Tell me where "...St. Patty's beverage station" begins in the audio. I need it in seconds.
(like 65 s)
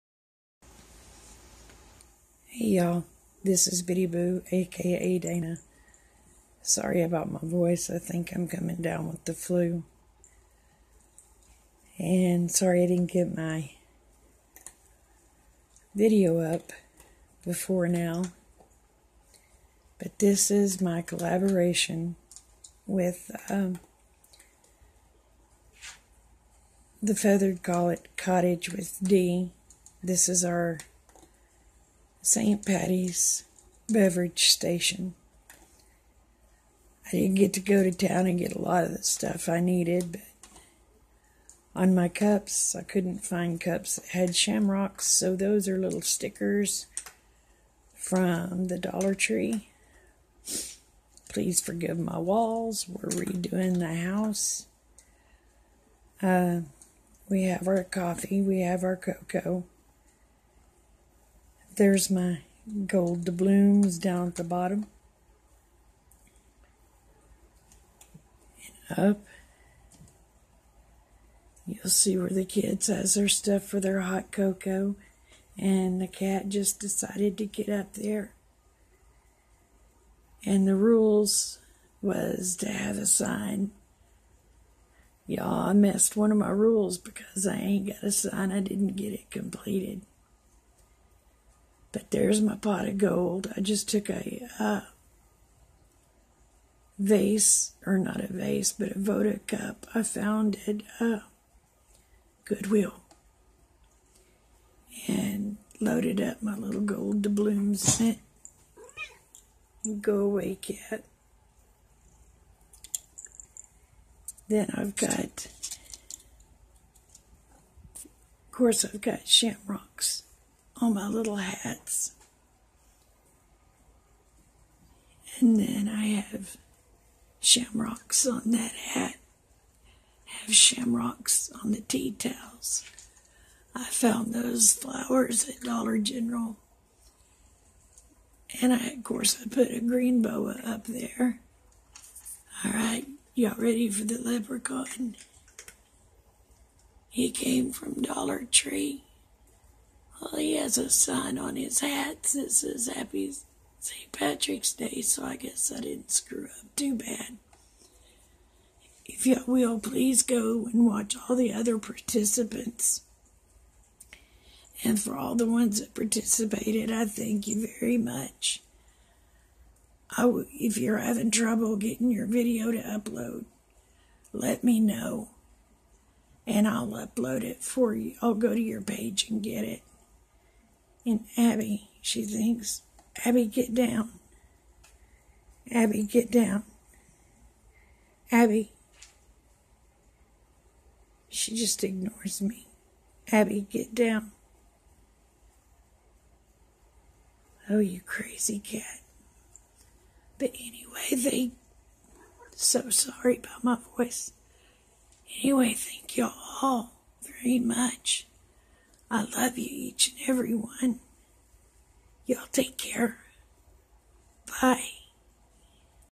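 32 s.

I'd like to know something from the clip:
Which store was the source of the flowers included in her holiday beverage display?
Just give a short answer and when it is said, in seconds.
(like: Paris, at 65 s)
Dollar General, at 135 s.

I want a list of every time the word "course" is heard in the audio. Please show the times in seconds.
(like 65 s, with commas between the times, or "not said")
118 s, 139 s.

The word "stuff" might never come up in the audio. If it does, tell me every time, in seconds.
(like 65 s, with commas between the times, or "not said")
39 s, 73 s.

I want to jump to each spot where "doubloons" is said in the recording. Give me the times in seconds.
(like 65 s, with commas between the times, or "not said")
63 s, 107 s.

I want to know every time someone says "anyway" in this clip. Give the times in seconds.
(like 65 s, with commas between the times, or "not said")
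200 s, 205 s.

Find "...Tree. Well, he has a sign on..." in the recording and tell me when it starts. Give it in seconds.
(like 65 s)
148 s.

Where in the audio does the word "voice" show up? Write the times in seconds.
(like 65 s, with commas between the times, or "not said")
7 s, 203 s.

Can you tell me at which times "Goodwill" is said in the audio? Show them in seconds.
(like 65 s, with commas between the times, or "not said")
102 s.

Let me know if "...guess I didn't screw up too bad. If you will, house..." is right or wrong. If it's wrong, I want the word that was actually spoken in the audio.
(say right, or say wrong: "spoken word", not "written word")
wrong: "please", not "house".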